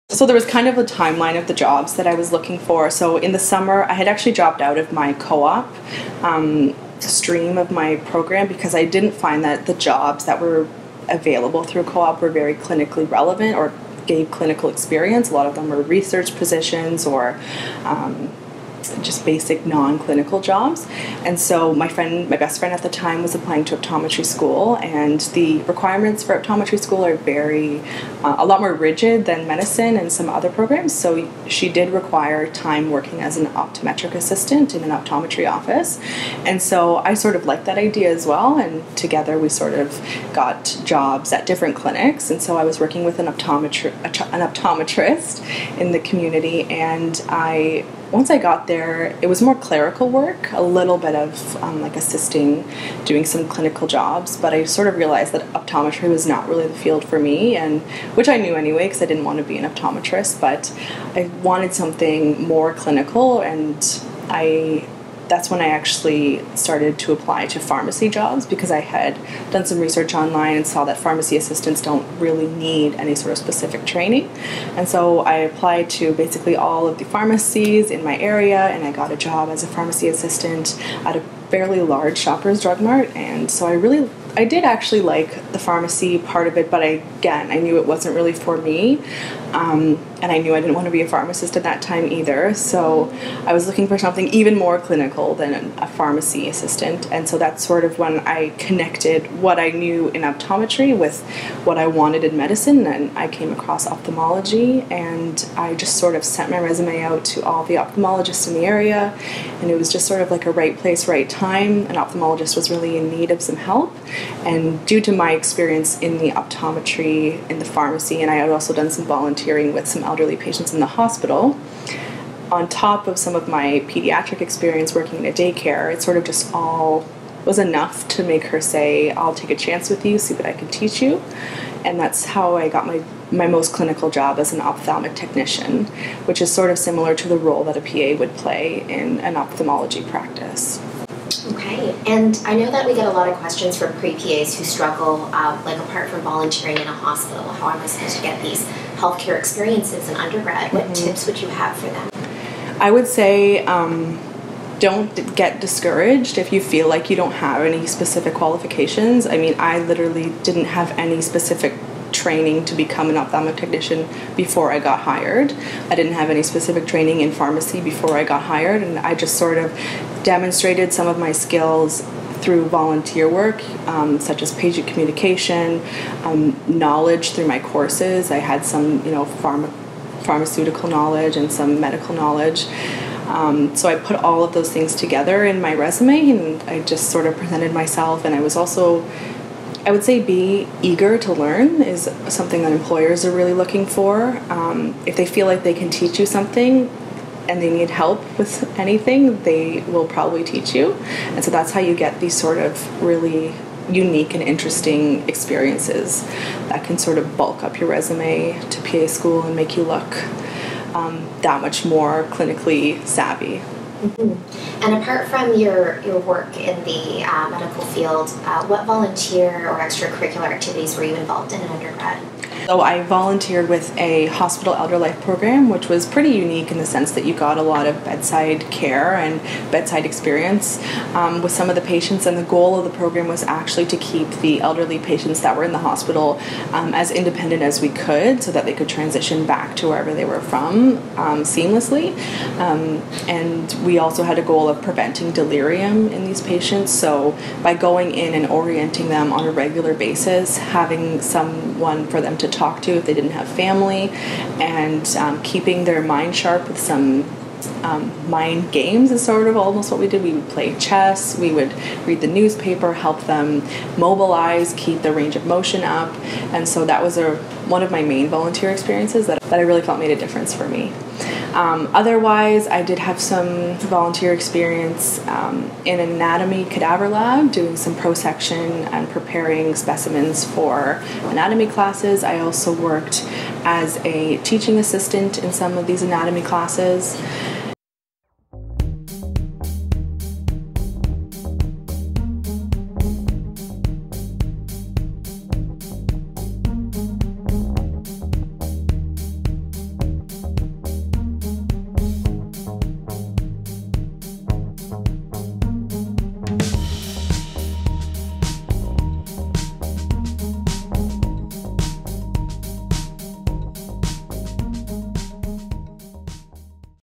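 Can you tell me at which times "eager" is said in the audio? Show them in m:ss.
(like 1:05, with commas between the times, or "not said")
3:10.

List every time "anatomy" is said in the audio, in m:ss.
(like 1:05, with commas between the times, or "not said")
4:35, 4:41, 4:46.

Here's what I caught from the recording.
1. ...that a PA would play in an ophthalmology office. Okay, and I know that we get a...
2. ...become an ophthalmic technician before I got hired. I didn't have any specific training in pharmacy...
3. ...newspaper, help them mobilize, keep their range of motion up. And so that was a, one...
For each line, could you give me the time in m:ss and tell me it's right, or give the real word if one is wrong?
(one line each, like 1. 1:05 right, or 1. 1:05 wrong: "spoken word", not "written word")
1. 2:17 wrong: "practice", not "office"
2. 2:42 right
3. 4:22 right.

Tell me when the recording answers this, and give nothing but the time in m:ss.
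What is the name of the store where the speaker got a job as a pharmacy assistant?
1:22.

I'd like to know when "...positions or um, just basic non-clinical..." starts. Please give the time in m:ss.
0:16.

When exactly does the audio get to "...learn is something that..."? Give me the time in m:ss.
3:11.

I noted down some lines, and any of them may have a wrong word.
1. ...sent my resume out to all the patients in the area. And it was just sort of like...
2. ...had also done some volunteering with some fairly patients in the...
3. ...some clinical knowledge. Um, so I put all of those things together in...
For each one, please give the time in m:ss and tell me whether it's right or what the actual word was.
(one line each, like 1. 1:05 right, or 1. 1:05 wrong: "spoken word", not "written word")
1. 1:46 wrong: "ophthalmologists", not "patients"
2. 1:58 wrong: "elderly", not "fairly"
3. 3:01 wrong: "medical", not "clinical".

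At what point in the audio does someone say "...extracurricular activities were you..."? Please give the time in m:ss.
3:39.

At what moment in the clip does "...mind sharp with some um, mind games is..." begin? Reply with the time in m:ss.
4:16.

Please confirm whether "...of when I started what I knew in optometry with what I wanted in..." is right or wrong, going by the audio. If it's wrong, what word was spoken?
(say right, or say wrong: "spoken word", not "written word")
wrong: "connected", not "started".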